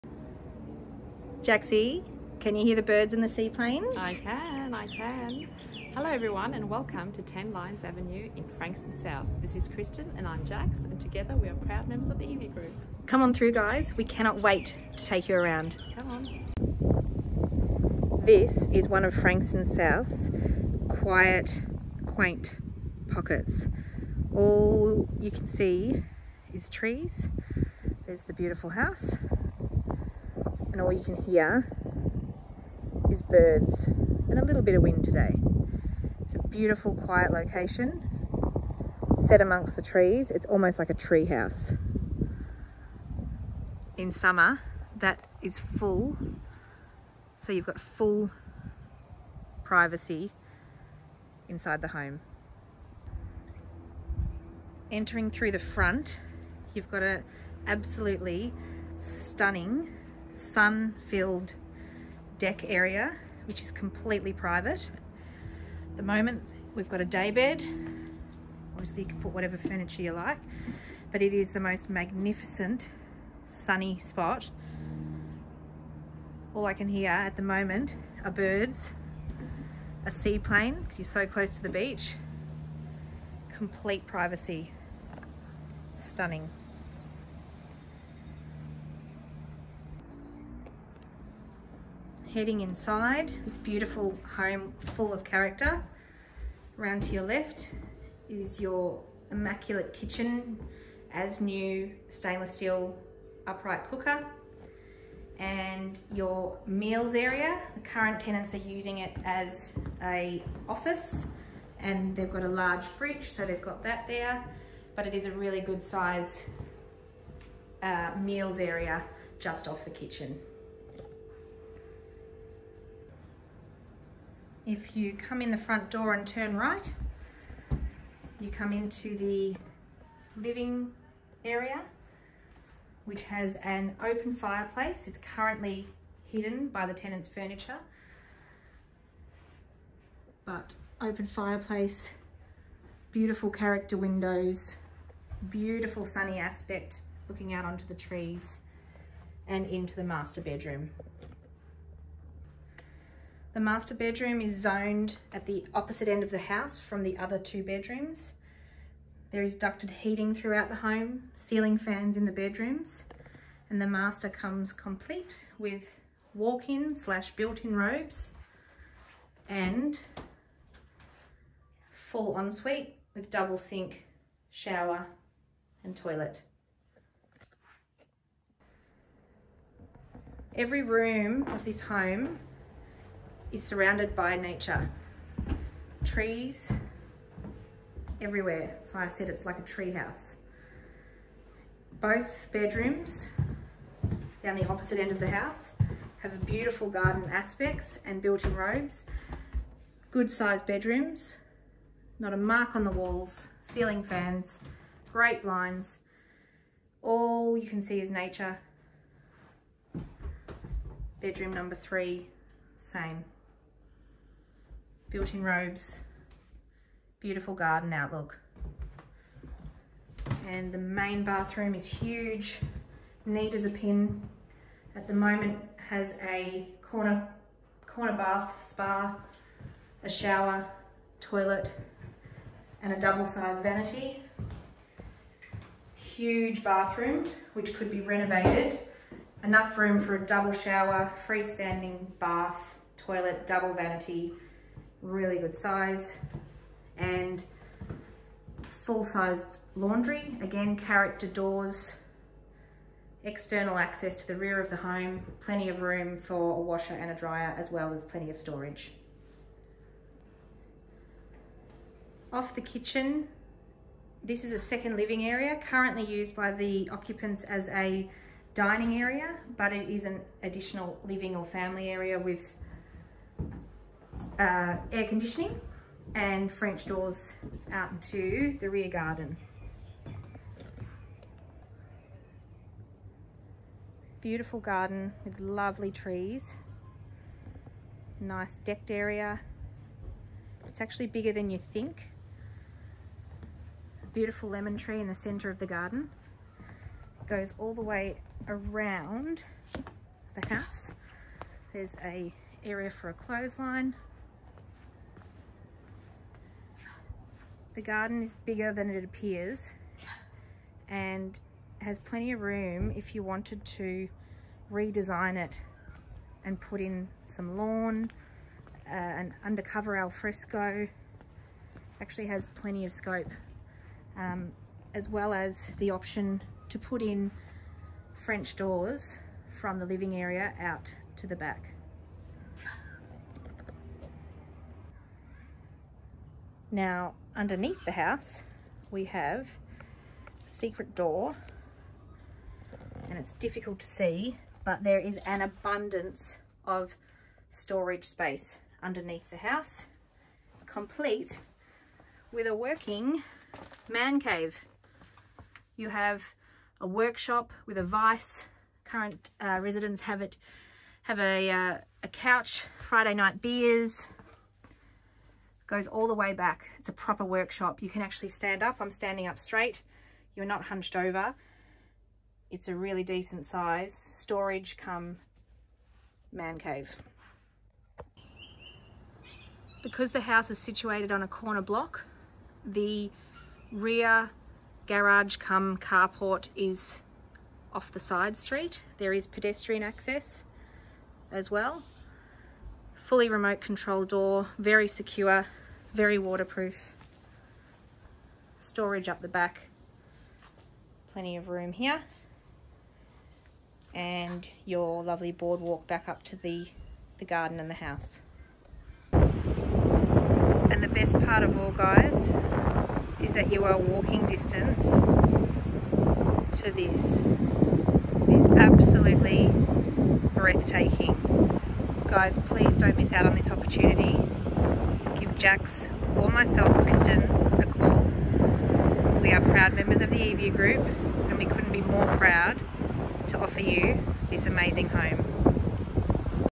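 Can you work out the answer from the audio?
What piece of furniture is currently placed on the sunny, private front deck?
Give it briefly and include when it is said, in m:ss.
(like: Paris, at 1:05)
A day bed, at 1:07.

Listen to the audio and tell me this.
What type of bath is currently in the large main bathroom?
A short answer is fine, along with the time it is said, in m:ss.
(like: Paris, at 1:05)
Corner bath, at 3:47.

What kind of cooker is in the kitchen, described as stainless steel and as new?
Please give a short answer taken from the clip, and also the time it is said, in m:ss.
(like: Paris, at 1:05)
Upright cooker, at 1:43.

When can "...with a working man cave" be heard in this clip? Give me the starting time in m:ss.
5:52.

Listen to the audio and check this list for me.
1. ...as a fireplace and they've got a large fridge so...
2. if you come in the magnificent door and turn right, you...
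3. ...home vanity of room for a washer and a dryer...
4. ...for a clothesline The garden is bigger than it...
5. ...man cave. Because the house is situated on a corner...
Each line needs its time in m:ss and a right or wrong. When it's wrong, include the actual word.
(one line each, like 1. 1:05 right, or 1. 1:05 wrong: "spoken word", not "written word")
1. 1:49 wrong: "office", not "fireplace"
2. 2:04 wrong: "front", not "magnificent"
3. 4:14 wrong: "plenty", not "vanity"
4. 5:02 right
5. 6:16 right.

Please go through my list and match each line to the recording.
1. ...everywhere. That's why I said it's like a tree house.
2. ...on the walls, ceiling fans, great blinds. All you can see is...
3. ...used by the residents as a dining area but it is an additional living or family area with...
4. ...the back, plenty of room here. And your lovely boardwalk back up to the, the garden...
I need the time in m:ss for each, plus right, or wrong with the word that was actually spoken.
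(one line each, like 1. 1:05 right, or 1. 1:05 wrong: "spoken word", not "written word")
1. 3:08 right
2. 3:22 right
3. 4:26 wrong: "occupants", not "residents"
4. 6:39 right.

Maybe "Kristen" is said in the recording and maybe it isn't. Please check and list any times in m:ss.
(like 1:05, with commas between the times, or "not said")
0:09, 7:06.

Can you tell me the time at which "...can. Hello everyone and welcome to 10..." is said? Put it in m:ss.
0:04.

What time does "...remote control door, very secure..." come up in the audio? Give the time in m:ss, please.
6:33.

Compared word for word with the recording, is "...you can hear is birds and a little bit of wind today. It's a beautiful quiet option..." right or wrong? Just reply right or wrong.
wrong.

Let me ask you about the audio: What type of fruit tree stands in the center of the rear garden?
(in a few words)
Lemon tree.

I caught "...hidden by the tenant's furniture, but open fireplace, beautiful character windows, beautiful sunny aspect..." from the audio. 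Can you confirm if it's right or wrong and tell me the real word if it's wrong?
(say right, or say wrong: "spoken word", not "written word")
right.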